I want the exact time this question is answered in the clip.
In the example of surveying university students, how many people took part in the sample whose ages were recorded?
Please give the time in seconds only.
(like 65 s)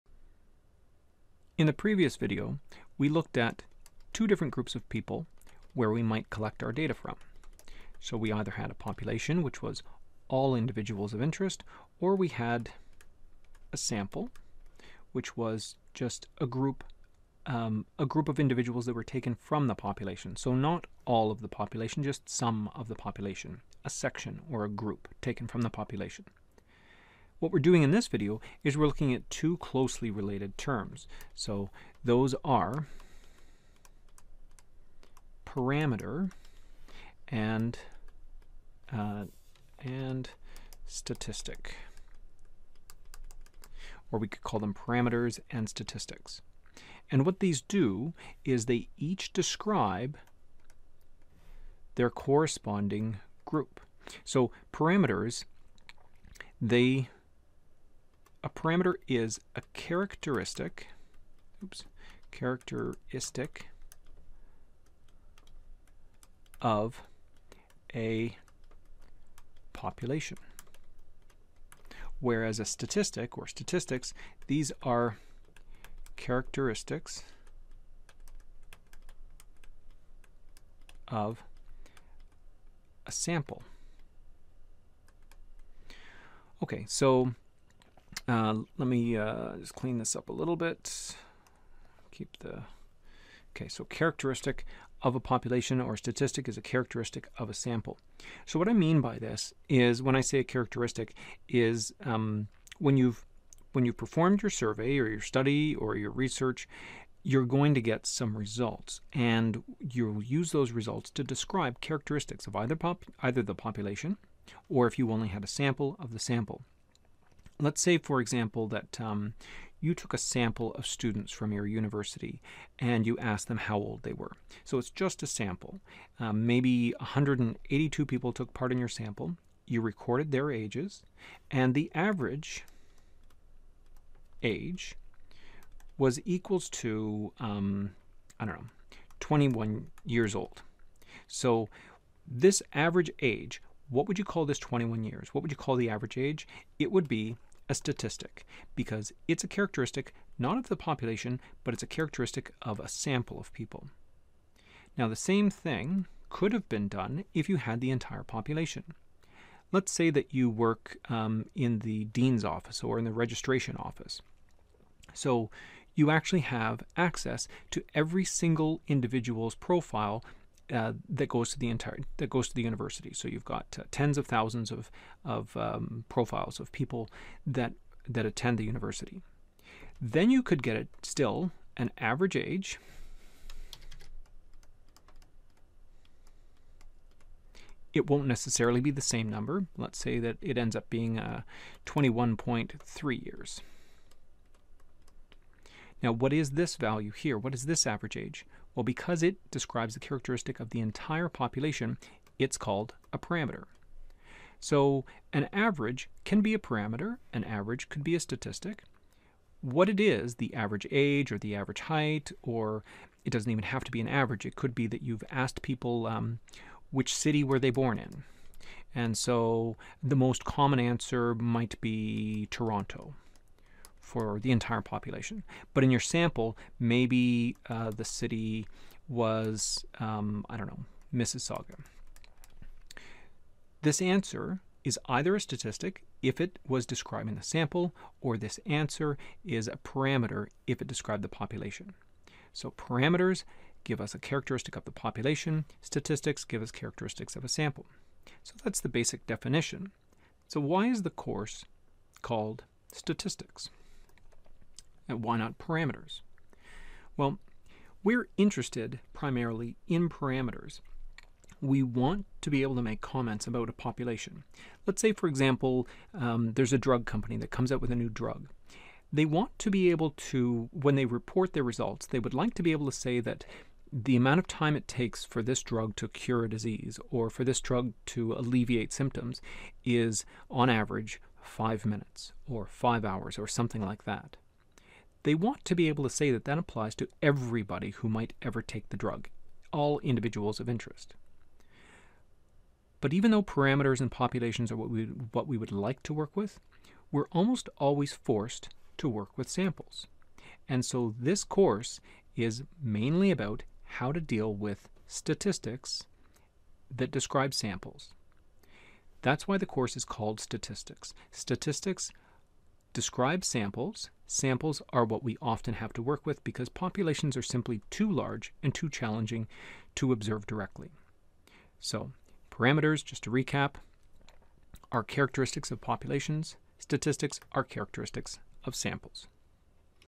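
126 s.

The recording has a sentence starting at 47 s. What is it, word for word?
And what these do is they each describe their corresponding group.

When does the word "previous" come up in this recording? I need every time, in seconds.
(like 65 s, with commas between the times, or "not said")
1 s.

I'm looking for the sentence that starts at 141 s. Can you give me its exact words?
So this average age, what would you call this 21 years?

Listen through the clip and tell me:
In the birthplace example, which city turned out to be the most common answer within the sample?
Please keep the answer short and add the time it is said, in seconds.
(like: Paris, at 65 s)
Mississauga, at 231 s.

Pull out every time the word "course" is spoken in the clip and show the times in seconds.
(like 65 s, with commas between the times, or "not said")
251 s, 301 s, 309 s.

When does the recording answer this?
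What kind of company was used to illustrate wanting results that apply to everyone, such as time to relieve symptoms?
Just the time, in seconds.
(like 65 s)
266 s.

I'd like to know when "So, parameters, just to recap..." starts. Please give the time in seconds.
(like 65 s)
321 s.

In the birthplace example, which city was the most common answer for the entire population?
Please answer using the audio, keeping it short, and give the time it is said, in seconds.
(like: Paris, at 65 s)
Toronto, at 222 s.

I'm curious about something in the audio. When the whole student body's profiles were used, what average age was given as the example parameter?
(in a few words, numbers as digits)
21.3 years.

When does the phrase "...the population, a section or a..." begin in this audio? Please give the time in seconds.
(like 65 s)
22 s.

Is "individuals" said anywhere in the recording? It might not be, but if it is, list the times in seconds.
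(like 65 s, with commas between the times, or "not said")
10 s, 18 s, 168 s, 289 s.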